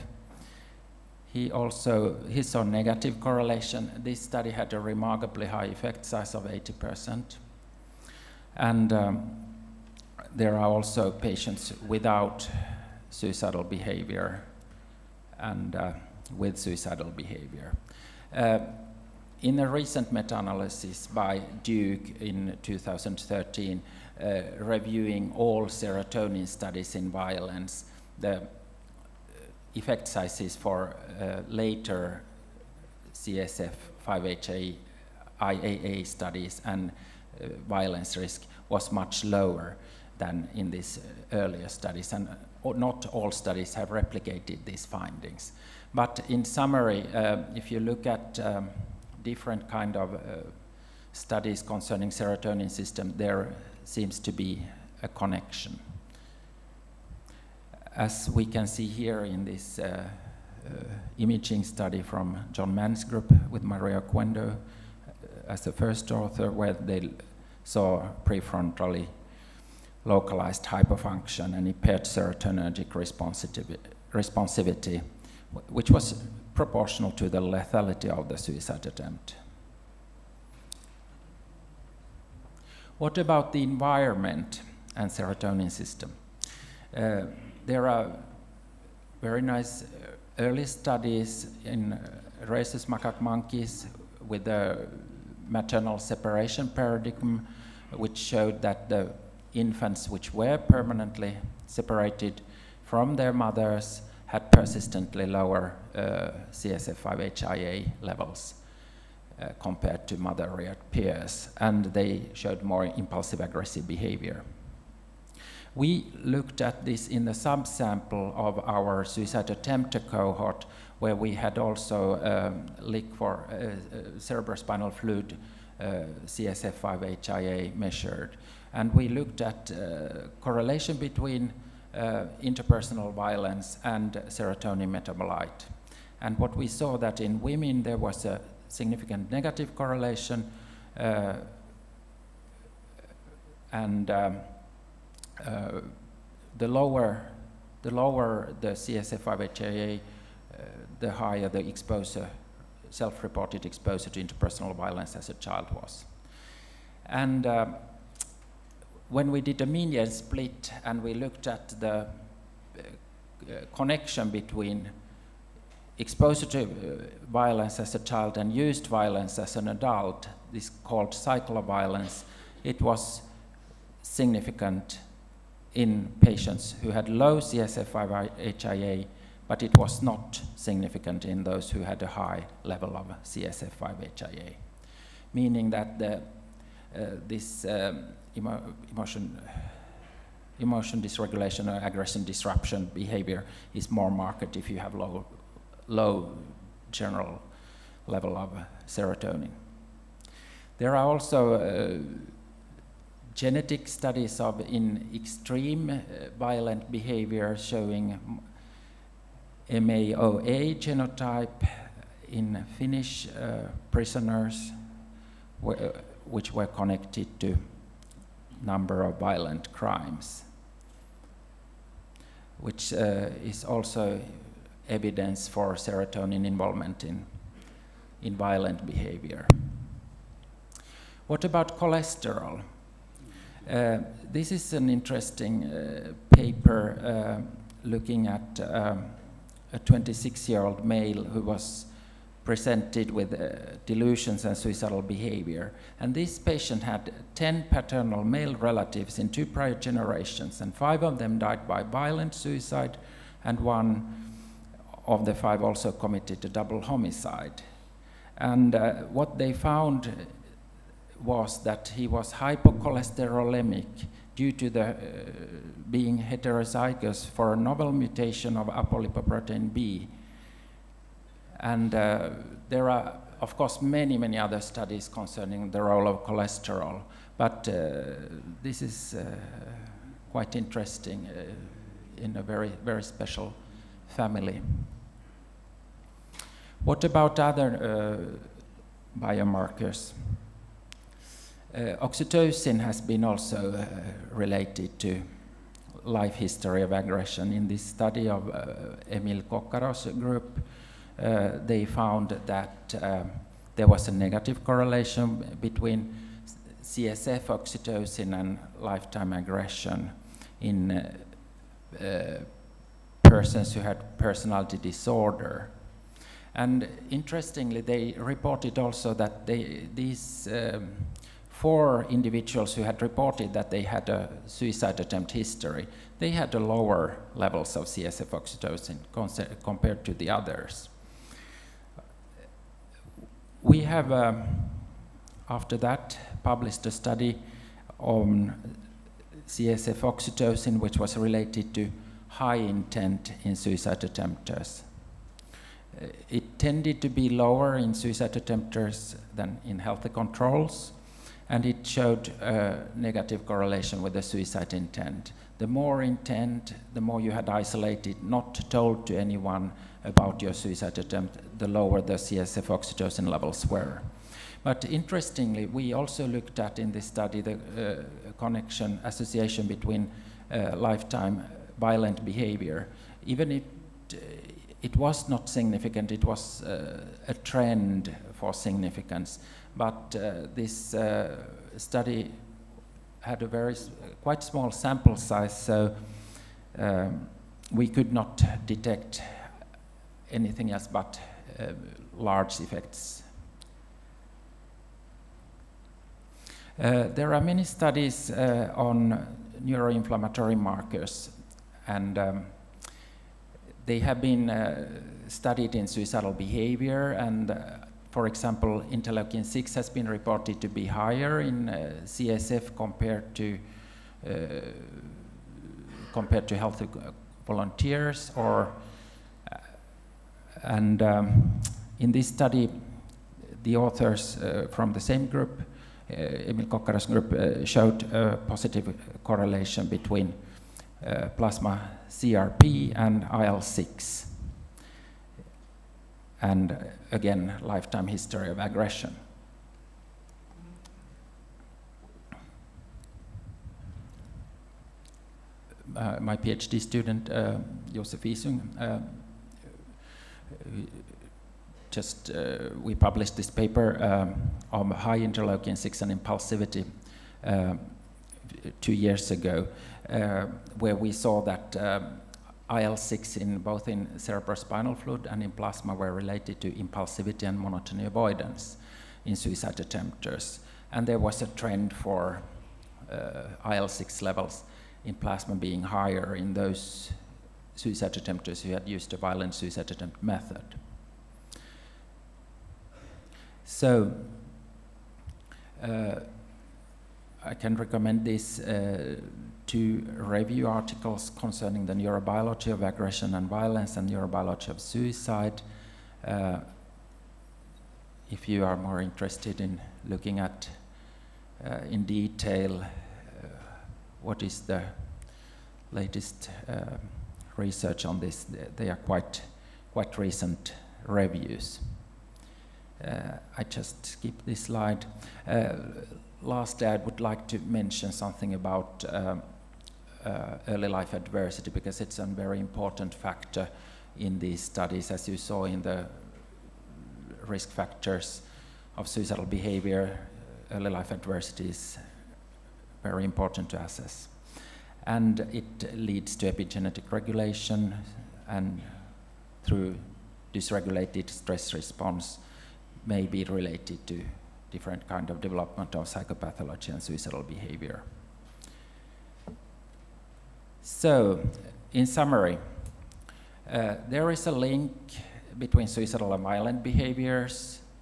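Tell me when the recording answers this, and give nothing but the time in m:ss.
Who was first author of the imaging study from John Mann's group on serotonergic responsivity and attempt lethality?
1:03.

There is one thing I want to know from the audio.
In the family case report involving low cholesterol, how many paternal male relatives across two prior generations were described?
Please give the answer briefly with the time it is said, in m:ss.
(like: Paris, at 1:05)
10, at 4:07.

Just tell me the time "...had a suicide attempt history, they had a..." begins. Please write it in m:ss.
5:23.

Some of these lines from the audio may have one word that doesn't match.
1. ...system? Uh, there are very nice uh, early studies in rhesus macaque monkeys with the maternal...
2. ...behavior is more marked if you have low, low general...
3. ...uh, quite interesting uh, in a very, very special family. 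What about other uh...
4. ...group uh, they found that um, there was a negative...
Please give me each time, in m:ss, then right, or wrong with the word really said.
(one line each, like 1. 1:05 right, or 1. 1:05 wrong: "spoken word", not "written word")
1. 1:25 right
2. 3:12 right
3. 4:39 right
4. 5:00 right.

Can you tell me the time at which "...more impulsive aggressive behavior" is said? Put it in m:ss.
1:52.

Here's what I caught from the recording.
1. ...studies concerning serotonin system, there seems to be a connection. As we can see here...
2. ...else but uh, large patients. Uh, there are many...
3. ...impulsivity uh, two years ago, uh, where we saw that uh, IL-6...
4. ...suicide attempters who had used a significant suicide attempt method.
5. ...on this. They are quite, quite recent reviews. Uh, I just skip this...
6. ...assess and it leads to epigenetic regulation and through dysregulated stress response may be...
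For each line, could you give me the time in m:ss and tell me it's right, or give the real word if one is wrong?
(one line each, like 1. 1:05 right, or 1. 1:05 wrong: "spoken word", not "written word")
1. 0:51 right
2. 6:30 wrong: "effects", not "patients"
3. 7:36 right
4. 7:57 wrong: "violent", not "significant"
5. 8:28 right
6. 8:53 right.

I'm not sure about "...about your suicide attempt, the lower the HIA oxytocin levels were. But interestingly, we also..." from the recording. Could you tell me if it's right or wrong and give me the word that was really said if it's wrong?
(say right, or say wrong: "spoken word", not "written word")
wrong: "CSF", not "HIA".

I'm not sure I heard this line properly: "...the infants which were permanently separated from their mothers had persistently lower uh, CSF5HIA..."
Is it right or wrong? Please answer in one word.
right.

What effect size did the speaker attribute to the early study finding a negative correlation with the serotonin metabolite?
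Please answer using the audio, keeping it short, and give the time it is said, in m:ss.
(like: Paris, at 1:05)
80%, at 0:06.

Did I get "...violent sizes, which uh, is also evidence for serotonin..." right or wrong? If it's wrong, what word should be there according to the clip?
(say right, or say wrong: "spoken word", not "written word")
wrong: "crimes", not "sizes".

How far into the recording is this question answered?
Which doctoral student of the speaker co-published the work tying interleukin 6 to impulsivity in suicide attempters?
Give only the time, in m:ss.
7:27.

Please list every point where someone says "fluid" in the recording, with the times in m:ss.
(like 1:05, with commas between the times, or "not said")
2:04, 7:44.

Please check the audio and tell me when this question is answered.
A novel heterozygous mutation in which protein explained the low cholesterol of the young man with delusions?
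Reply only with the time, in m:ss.
4:28.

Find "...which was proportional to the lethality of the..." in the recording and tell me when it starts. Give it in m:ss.
1:15.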